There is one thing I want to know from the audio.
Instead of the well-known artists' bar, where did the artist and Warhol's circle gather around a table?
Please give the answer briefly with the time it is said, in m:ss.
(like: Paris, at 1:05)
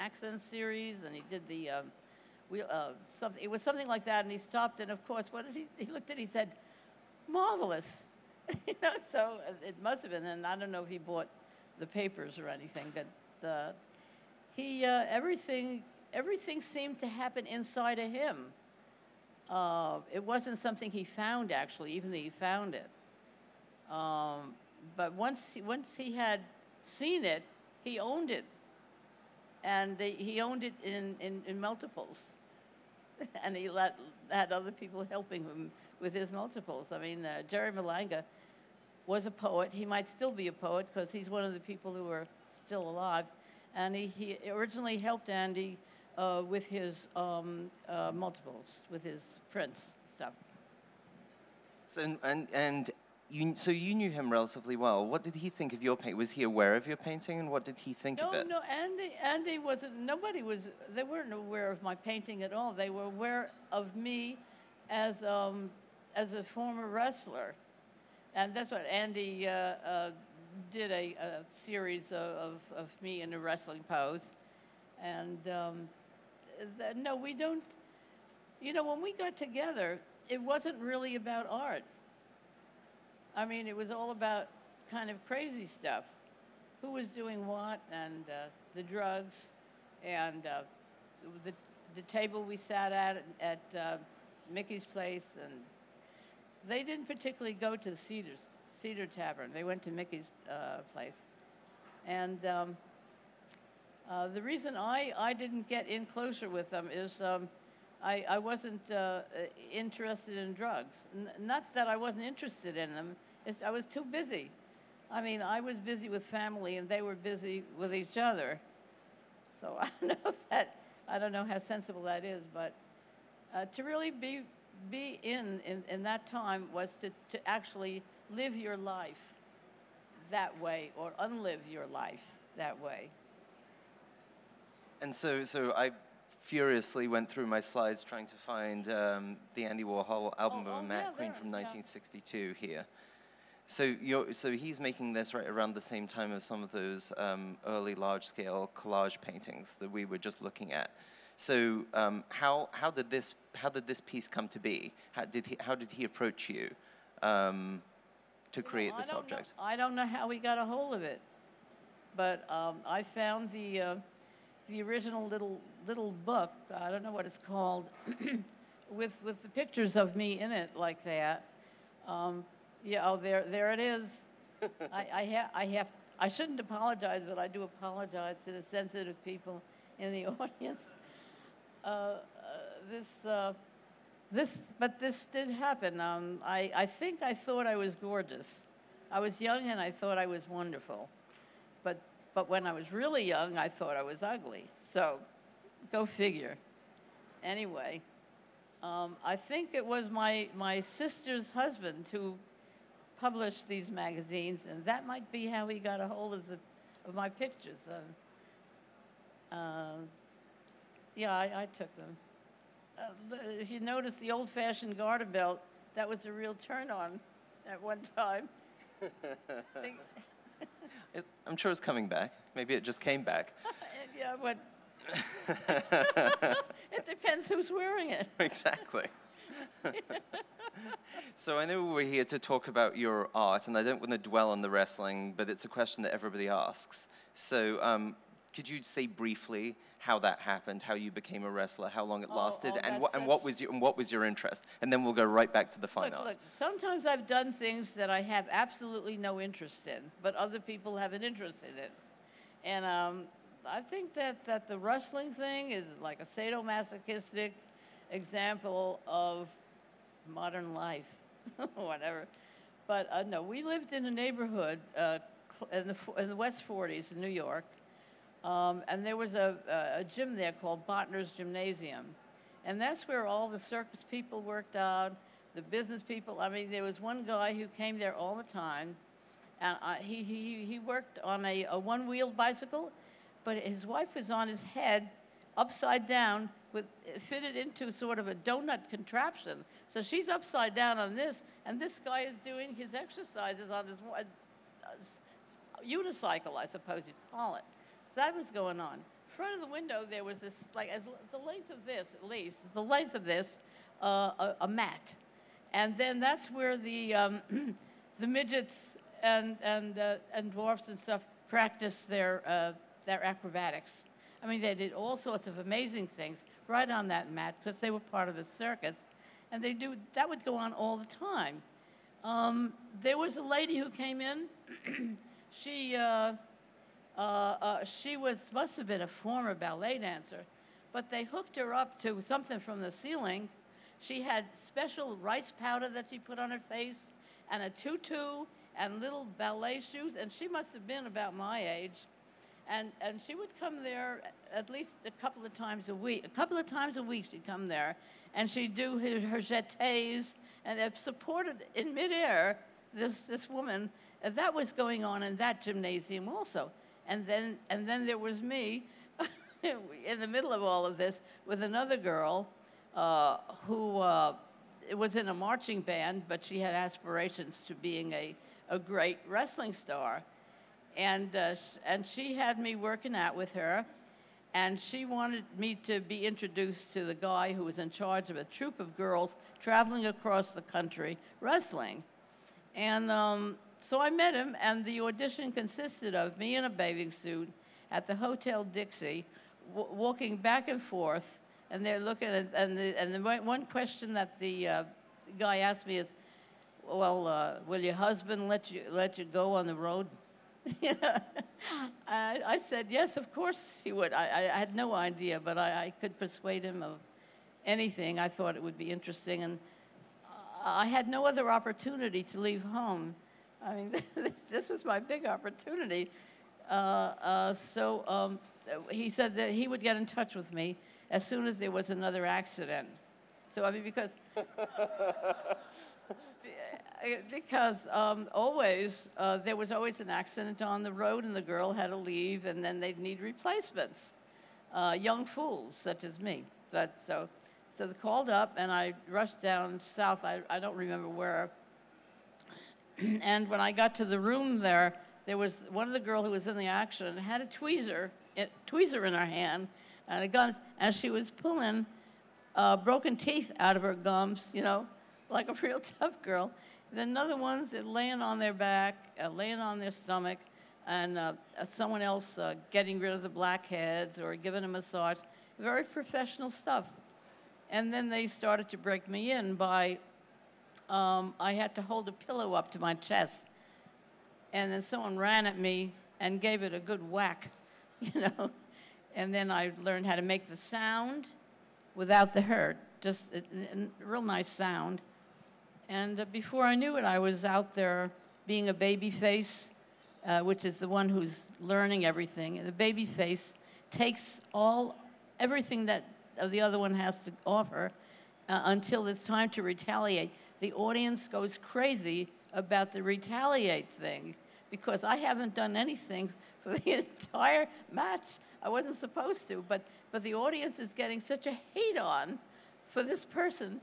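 Mickey's place, at 1:34.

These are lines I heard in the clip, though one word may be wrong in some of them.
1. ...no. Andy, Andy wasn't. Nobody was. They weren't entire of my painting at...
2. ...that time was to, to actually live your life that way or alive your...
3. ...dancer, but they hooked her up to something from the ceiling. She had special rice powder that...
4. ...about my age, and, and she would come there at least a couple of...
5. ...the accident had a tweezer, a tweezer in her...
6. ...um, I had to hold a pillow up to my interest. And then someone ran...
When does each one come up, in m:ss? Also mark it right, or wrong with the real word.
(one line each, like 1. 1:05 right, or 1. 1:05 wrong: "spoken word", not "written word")
1. 0:58 wrong: "aware", not "entire"
2. 2:06 wrong: "unlive", not "alive"
3. 5:29 right
4. 5:41 right
5. 7:26 right
6. 7:50 wrong: "chest", not "interest".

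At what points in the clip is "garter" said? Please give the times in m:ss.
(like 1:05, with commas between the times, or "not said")
3:34.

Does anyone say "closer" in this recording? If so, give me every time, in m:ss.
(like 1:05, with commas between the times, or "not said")
1:46.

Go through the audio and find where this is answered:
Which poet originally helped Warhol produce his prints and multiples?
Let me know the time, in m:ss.
0:37.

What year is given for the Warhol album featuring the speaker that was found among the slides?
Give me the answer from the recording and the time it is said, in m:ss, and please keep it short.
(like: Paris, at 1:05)
1962, at 2:21.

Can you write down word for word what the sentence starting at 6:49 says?
And I had no other opportunity to leave home.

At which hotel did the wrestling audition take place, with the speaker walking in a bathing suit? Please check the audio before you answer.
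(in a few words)
Hotel Dixie.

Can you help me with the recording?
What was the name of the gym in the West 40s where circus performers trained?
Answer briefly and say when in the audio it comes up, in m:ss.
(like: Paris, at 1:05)
Bothner's Gymnasium, at 4:30.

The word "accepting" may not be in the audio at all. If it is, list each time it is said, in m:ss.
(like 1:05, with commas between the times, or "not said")
not said.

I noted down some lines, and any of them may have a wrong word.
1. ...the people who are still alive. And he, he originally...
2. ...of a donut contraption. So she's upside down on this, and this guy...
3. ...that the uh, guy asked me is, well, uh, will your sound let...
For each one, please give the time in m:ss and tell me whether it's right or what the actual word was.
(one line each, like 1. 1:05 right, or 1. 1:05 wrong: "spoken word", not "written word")
1. 0:41 right
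2. 4:48 right
3. 6:34 wrong: "husband", not "sound".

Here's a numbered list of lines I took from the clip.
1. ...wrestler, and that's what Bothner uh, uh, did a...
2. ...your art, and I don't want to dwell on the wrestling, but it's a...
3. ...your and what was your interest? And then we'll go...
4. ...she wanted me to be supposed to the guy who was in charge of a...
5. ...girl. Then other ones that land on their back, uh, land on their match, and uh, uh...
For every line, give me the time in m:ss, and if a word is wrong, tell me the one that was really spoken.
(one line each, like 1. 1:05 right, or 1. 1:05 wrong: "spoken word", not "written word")
1. 1:06 wrong: "Andy", not "Bothner"
2. 3:52 right
3. 4:03 right
4. 6:14 wrong: "introduced", not "supposed"
5. 7:36 wrong: "stomach", not "match".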